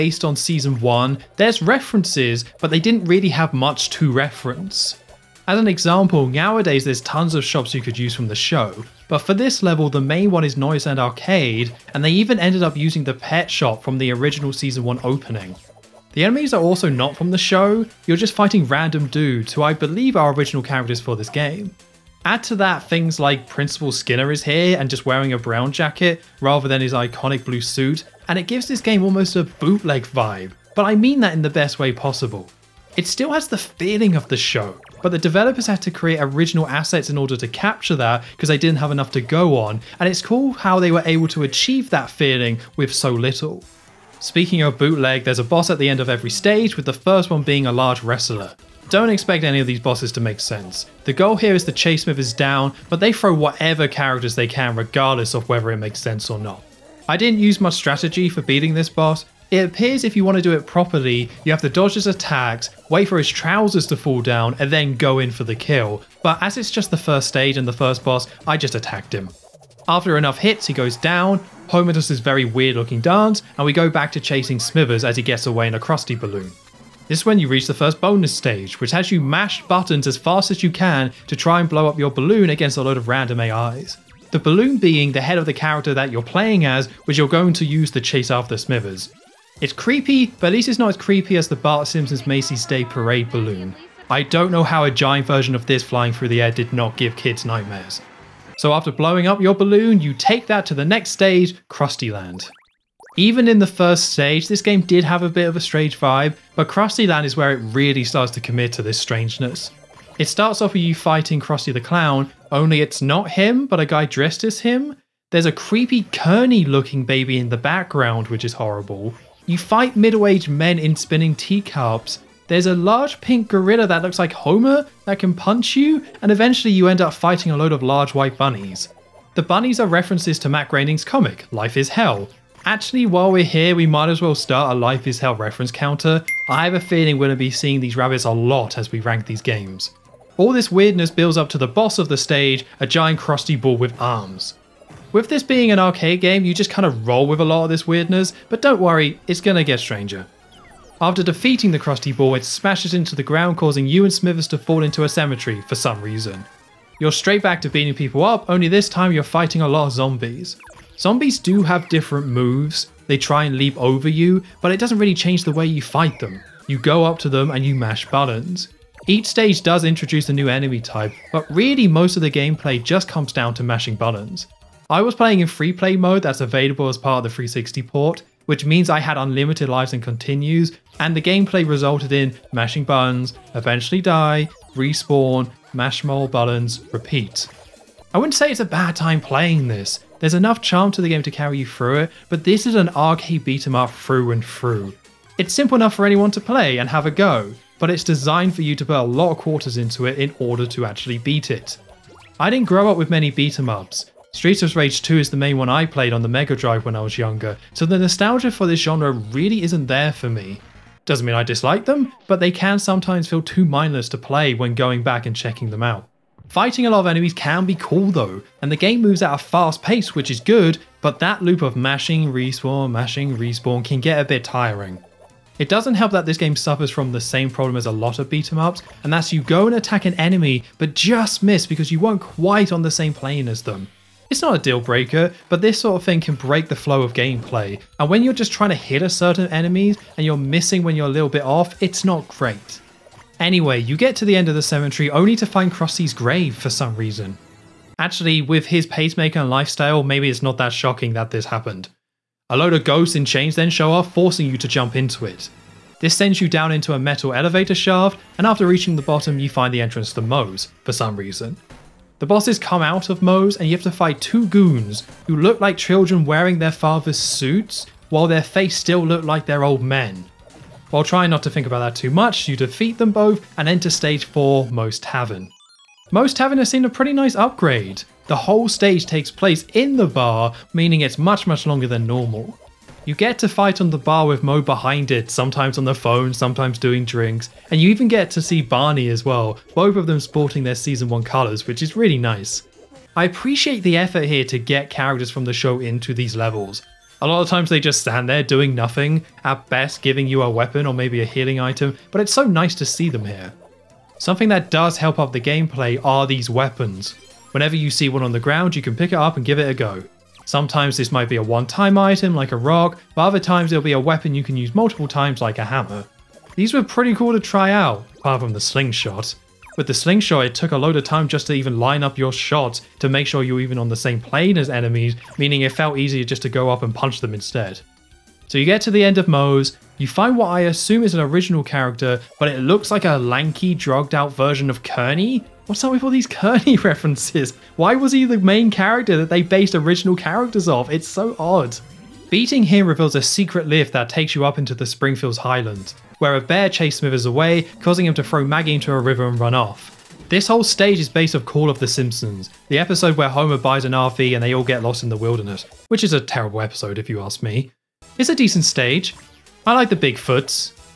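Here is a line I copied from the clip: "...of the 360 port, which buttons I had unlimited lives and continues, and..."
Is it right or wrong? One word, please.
wrong.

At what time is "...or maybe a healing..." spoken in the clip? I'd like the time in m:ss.
5:00.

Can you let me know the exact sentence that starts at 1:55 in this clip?
There's a creepy Kearney looking baby in the background, which is horrible.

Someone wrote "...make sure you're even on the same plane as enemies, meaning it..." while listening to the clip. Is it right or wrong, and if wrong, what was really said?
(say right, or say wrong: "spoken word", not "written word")
right.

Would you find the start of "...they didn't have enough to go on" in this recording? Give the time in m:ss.
0:38.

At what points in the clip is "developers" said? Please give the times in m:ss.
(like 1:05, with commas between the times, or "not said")
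0:35.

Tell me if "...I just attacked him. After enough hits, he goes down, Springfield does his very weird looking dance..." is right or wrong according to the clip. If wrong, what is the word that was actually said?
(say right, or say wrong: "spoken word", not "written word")
wrong: "Homer", not "Springfield".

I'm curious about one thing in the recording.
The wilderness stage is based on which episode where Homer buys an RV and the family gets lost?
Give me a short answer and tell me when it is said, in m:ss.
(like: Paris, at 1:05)
Call of the Simpsons, at 5:51.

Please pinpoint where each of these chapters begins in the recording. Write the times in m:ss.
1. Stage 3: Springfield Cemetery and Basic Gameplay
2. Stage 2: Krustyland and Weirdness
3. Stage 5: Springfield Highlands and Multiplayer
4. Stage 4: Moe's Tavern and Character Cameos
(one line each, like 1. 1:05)
1. 2:28
2. 1:38
3. 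5:40
4. 4:12.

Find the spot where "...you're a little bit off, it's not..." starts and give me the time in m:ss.
4:00.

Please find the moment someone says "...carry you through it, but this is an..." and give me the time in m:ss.
3:11.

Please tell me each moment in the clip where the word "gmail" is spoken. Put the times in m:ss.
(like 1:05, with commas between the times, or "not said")
not said.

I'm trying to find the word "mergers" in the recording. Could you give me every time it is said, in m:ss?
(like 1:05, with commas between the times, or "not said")
not said.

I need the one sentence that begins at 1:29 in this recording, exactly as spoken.
It's creepy, but at least it's not as creepy as the Bart Simpson's Macy's Day Parade balloon.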